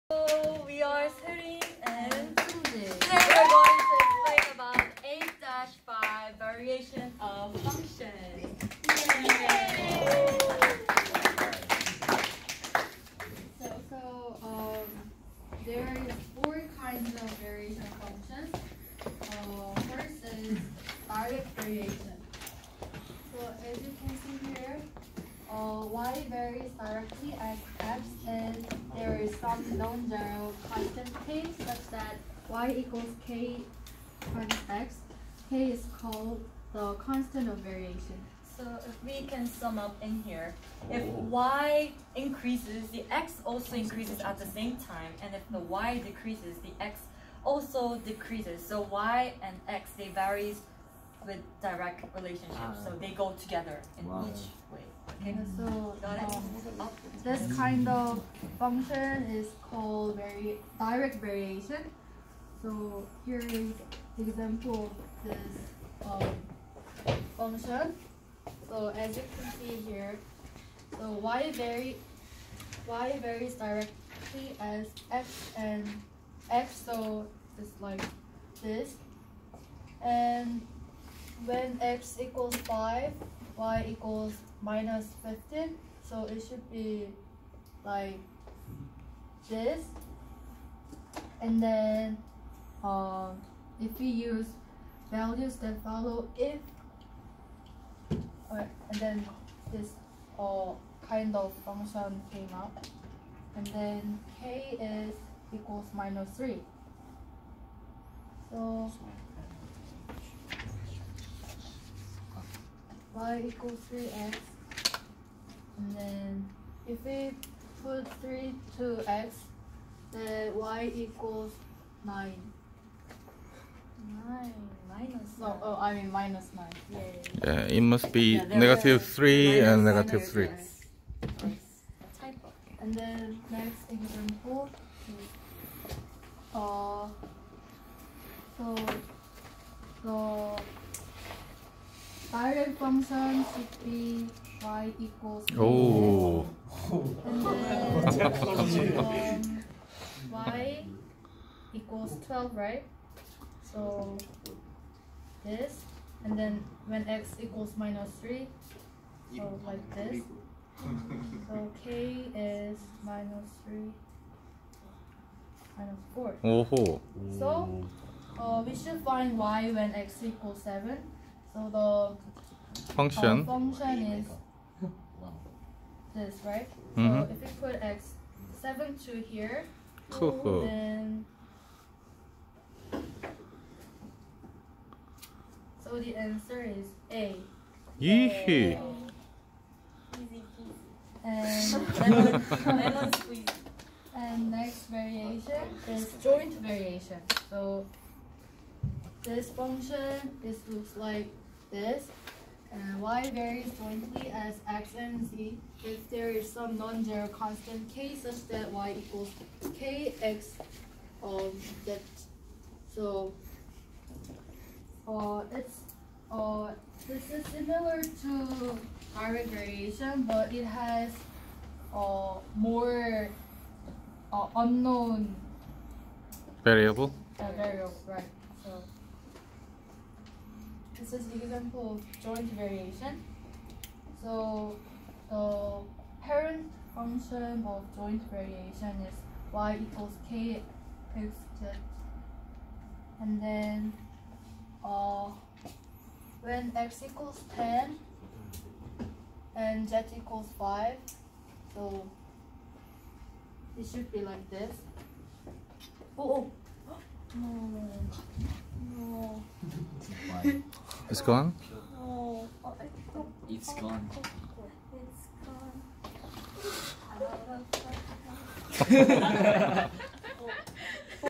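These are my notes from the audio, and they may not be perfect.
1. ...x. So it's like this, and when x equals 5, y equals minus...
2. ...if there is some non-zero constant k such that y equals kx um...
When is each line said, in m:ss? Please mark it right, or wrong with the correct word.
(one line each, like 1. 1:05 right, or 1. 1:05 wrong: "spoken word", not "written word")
1. 1:16 right
2. 3:25 right.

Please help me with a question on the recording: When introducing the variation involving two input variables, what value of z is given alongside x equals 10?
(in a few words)
5.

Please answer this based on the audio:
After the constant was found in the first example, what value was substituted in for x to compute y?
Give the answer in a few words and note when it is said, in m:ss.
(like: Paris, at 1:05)
3, at 1:57.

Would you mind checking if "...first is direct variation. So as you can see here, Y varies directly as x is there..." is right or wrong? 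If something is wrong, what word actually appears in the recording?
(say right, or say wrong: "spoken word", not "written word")
right.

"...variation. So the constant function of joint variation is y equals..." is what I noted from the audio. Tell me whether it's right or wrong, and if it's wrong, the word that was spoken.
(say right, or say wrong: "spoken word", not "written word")
wrong: "parent", not "constant".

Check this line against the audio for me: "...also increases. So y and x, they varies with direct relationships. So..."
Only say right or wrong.
wrong.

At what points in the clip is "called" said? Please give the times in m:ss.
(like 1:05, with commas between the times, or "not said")
0:36, 0:59.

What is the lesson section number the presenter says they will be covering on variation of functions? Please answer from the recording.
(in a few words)
8-5.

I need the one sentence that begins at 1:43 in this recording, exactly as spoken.
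And then k is equals minus 3.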